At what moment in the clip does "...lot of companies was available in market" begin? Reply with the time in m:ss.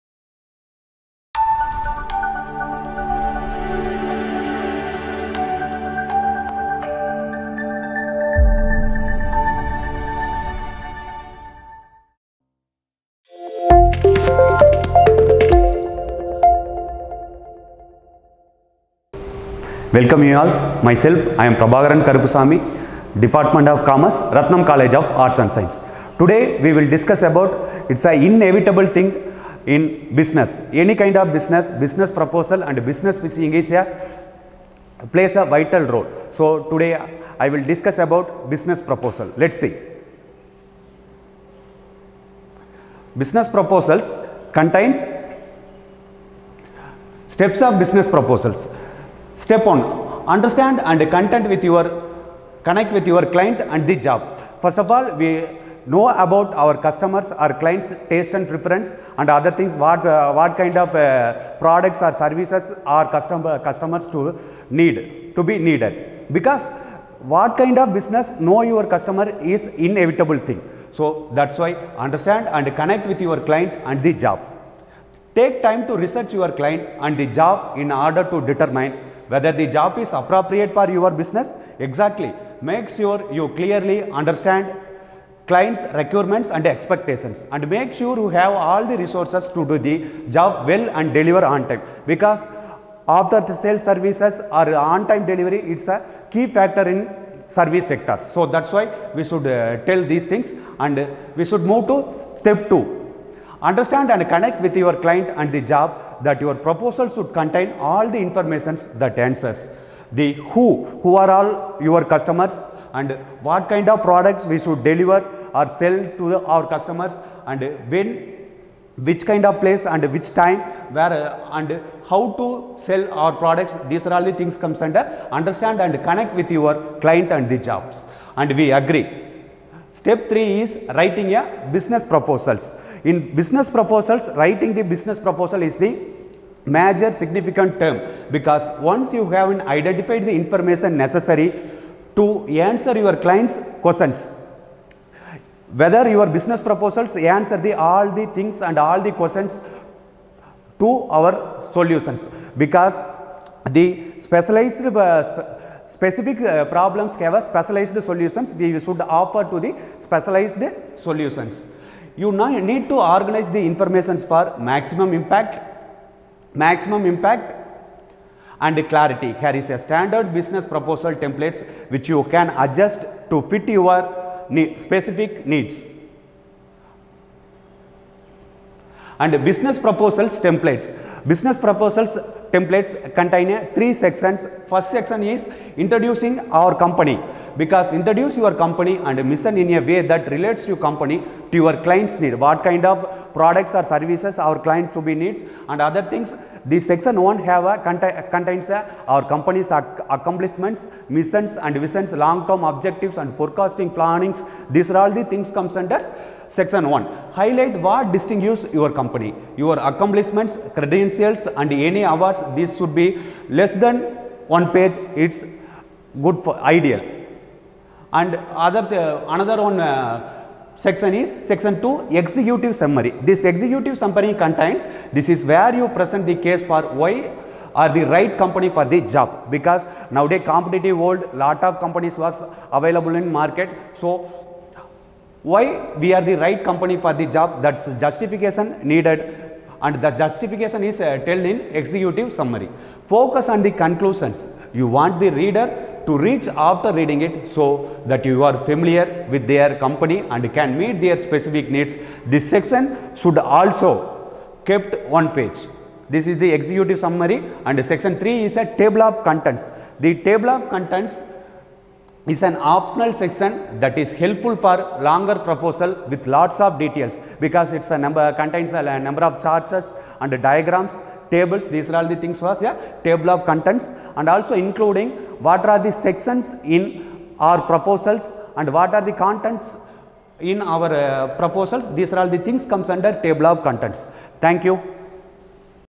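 3:51.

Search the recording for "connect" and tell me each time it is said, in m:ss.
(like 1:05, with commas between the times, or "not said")
0:52, 1:12, 1:44, 2:06.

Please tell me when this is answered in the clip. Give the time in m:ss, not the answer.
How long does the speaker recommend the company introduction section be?
3:33.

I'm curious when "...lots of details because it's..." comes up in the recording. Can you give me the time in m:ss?
4:26.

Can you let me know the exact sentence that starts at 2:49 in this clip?
Here is a standard business proposal templates which you can adjust to fit your specific needs.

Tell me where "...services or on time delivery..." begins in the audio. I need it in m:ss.
1:33.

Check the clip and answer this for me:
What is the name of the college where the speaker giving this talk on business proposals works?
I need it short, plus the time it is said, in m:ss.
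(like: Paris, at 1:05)
Rathinam College of Arts and Science, at 0:24.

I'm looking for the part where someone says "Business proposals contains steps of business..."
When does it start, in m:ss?
0:43.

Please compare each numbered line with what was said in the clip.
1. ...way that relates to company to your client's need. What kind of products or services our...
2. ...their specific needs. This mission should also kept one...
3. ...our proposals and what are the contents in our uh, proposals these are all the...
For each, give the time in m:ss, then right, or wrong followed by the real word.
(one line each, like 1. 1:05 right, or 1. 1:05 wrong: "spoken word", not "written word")
1. 3:09 right
2. 4:11 wrong: "section", not "mission"
3. 4:37 right.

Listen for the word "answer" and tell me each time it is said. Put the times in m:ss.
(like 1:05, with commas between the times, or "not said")
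1:49, 2:22, 2:27.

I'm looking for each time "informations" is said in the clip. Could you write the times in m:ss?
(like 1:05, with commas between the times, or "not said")
1:48, 2:20, 2:43.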